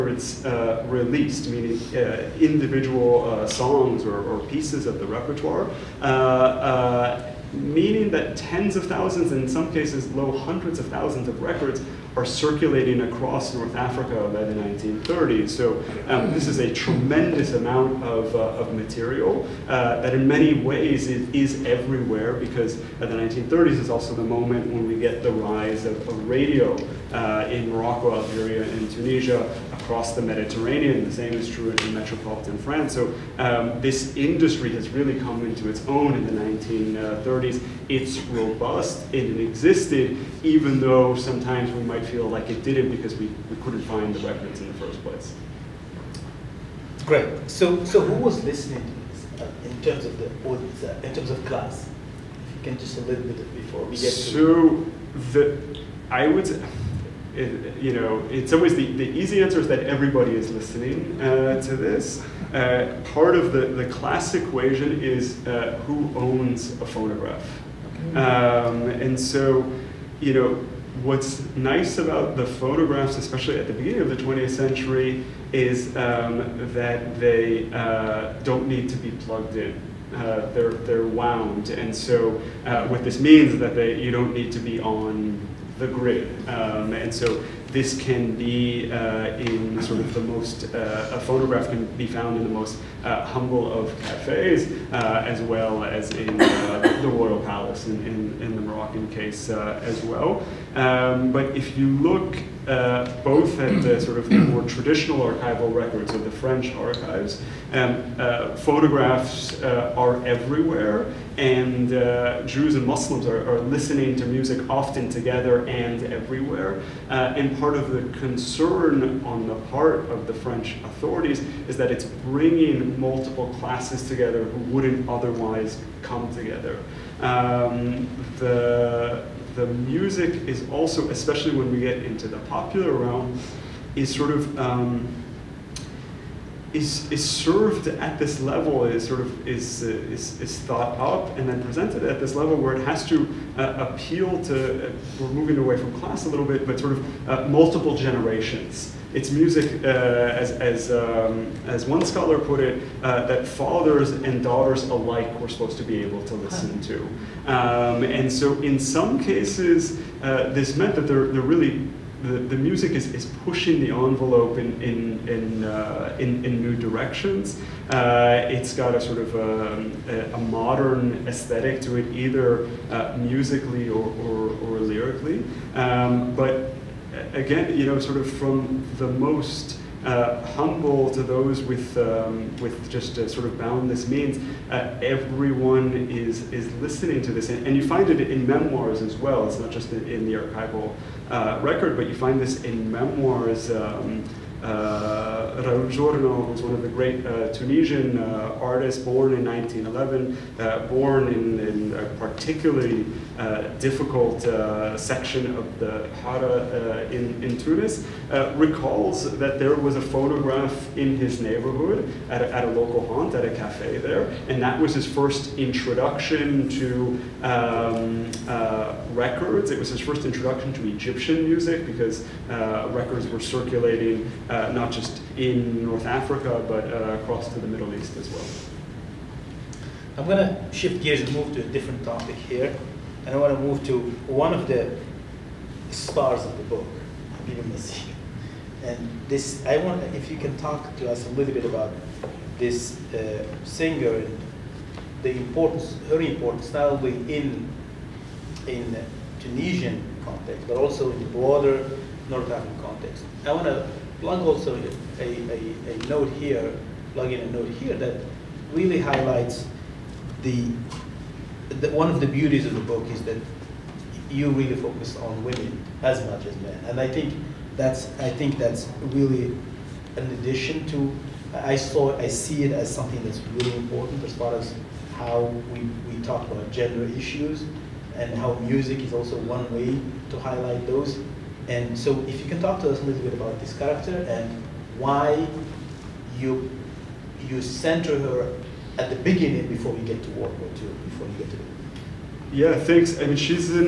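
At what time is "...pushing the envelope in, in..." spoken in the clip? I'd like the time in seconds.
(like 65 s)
163 s.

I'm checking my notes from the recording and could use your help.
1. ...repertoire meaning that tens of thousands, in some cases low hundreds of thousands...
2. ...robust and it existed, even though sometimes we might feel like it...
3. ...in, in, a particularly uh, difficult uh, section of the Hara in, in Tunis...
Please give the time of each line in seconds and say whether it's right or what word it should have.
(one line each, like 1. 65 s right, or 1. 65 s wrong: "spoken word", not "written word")
1. 5 s right
2. 38 s right
3. 201 s right.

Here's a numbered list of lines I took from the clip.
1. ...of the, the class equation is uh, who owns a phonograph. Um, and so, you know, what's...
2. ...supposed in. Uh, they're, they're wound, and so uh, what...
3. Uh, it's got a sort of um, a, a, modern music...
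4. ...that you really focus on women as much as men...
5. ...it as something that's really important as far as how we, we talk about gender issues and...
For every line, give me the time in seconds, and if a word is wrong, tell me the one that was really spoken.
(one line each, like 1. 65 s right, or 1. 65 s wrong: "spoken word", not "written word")
1. 63 s right
2. 79 s wrong: "plugged", not "supposed"
3. 167 s wrong: "aesthetic", not "music"
4. 263 s right
5. 272 s right.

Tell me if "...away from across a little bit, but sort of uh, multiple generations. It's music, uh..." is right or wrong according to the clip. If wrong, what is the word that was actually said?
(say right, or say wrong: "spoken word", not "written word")
wrong: "class", not "across".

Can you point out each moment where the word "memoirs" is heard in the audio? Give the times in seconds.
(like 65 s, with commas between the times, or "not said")
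188 s, 192 s.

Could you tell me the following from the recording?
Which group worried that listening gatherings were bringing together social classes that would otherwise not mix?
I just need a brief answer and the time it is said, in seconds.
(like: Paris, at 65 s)
French authorities, at 120 s.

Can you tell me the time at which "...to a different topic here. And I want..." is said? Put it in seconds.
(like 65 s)
231 s.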